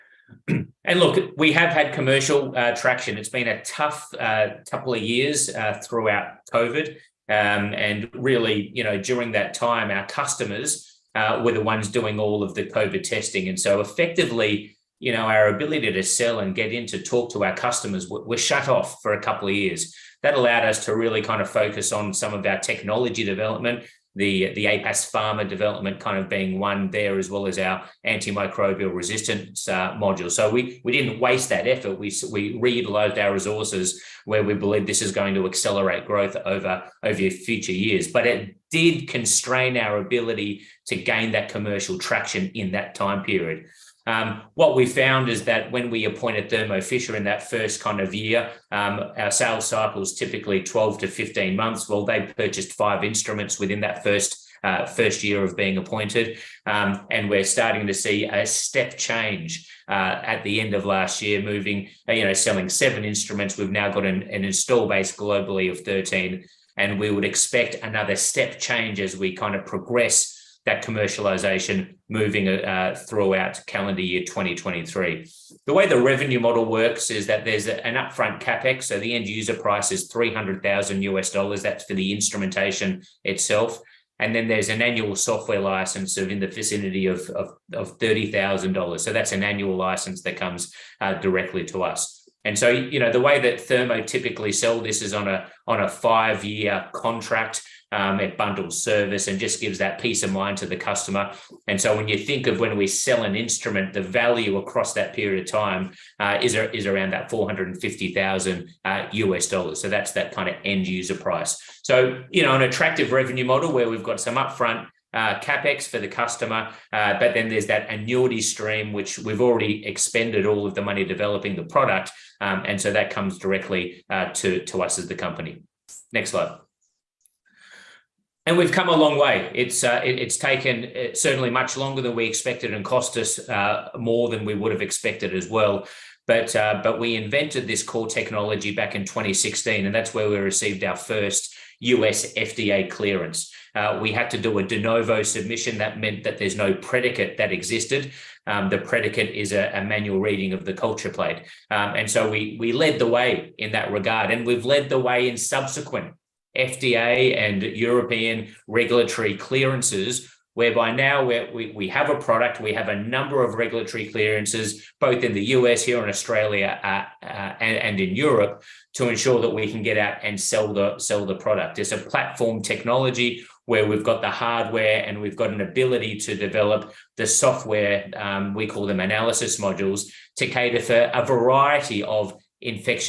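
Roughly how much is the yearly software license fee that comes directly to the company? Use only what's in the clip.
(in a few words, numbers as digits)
$30,000.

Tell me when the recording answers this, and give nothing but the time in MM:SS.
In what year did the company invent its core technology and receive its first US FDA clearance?
02:19.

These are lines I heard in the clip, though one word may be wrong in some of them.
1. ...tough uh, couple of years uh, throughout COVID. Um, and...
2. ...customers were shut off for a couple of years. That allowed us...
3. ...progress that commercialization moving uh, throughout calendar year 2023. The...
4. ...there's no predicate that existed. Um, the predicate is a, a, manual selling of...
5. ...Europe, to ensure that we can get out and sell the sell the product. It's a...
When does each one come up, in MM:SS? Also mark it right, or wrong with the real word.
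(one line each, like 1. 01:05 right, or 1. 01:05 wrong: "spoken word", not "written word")
1. 00:03 right
2. 00:17 right
3. 01:09 right
4. 02:26 wrong: "reading", not "selling"
5. 02:48 right.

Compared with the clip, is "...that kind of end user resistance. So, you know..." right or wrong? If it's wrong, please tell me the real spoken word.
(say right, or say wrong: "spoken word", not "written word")
wrong: "price", not "resistance".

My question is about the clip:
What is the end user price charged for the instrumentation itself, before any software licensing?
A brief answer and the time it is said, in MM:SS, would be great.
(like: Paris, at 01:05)
$300,000, at 01:20.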